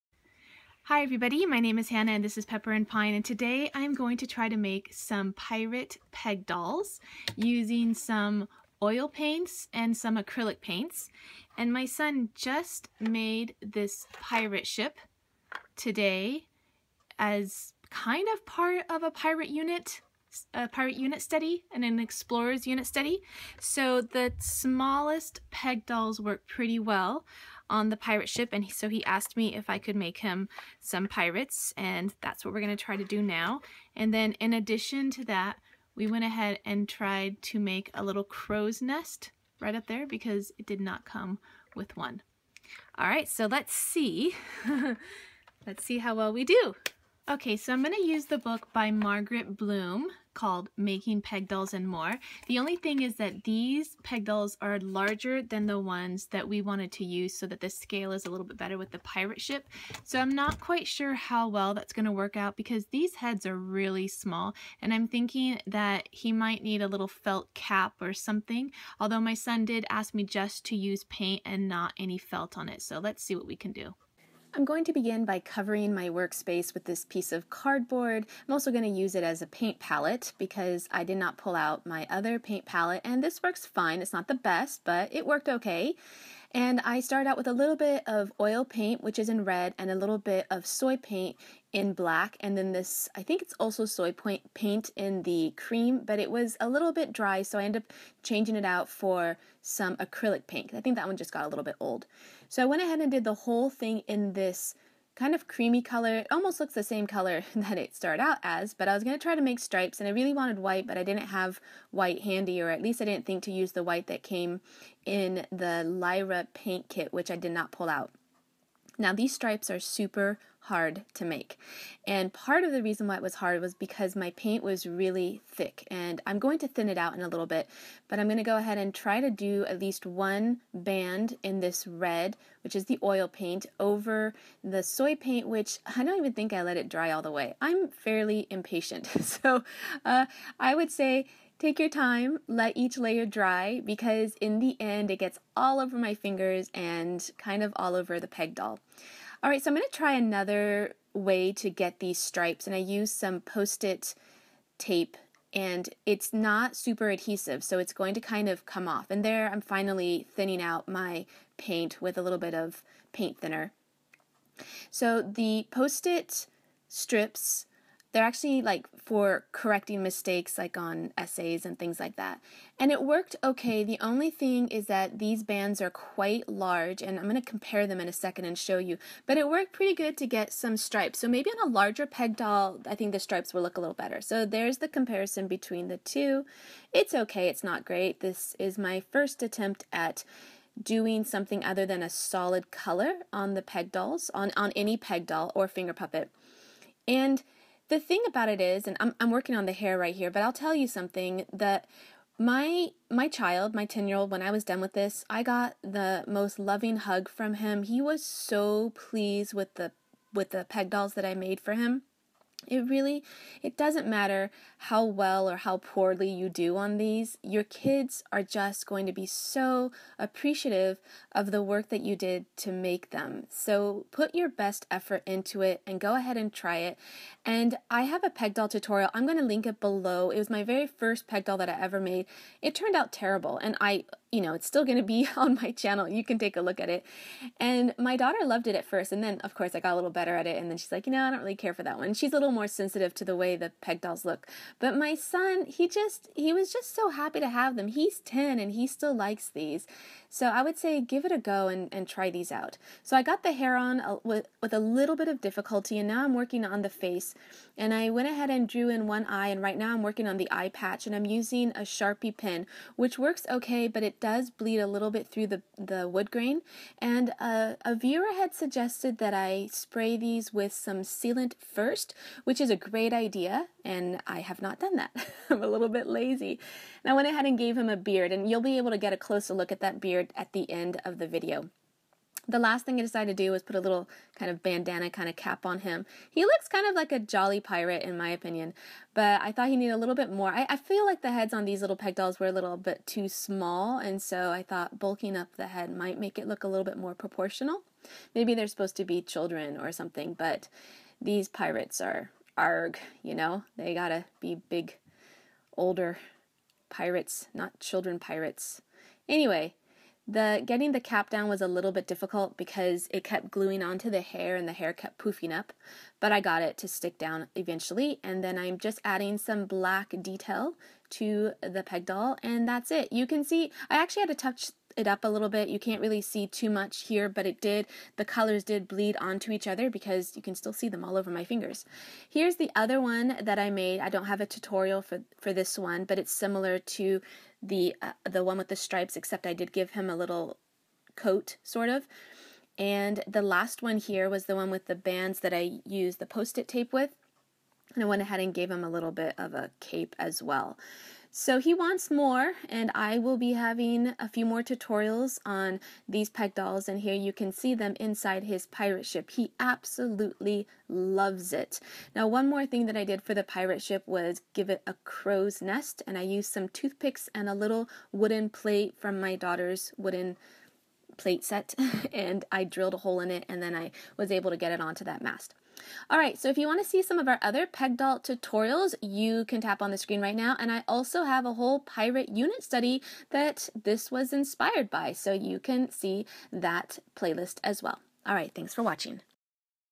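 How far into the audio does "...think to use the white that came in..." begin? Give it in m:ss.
1:53.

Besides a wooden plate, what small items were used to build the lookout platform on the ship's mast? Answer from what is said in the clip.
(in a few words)
Toothpicks.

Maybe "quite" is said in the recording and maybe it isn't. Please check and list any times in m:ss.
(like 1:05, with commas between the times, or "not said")
1:00, 2:55.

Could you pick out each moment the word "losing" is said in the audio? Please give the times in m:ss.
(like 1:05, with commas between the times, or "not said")
not said.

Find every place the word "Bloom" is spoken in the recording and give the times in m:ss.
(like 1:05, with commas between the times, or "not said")
0:49.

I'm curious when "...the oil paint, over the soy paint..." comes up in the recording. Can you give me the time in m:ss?
2:12.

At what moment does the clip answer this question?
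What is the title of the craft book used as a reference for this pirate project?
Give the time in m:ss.
0:50.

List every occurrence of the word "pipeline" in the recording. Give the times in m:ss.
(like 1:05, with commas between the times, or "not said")
not said.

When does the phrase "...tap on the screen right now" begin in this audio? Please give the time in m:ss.
6:19.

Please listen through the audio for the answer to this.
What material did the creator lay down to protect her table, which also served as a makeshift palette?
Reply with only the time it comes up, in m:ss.
1:17.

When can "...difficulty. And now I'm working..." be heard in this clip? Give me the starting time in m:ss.
4:15.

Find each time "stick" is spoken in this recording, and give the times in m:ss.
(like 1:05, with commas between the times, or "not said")
5:16.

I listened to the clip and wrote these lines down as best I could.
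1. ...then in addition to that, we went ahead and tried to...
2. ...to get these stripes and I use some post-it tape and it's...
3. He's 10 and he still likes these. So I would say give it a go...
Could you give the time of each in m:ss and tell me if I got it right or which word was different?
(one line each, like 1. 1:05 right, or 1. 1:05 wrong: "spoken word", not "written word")
1. 0:34 right
2. 2:31 right
3. 4:07 right.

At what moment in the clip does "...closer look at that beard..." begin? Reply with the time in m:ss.
4:39.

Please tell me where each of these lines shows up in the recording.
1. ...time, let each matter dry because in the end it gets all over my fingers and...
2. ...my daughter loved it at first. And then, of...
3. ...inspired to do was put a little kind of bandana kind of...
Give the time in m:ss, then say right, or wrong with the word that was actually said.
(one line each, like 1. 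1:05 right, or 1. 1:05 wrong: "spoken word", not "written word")
1. 2:21 wrong: "layer", not "matter"
2. 3:57 right
3. 4:43 wrong: "decided", not "inspired".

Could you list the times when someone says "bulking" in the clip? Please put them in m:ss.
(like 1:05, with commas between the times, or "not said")
4:54.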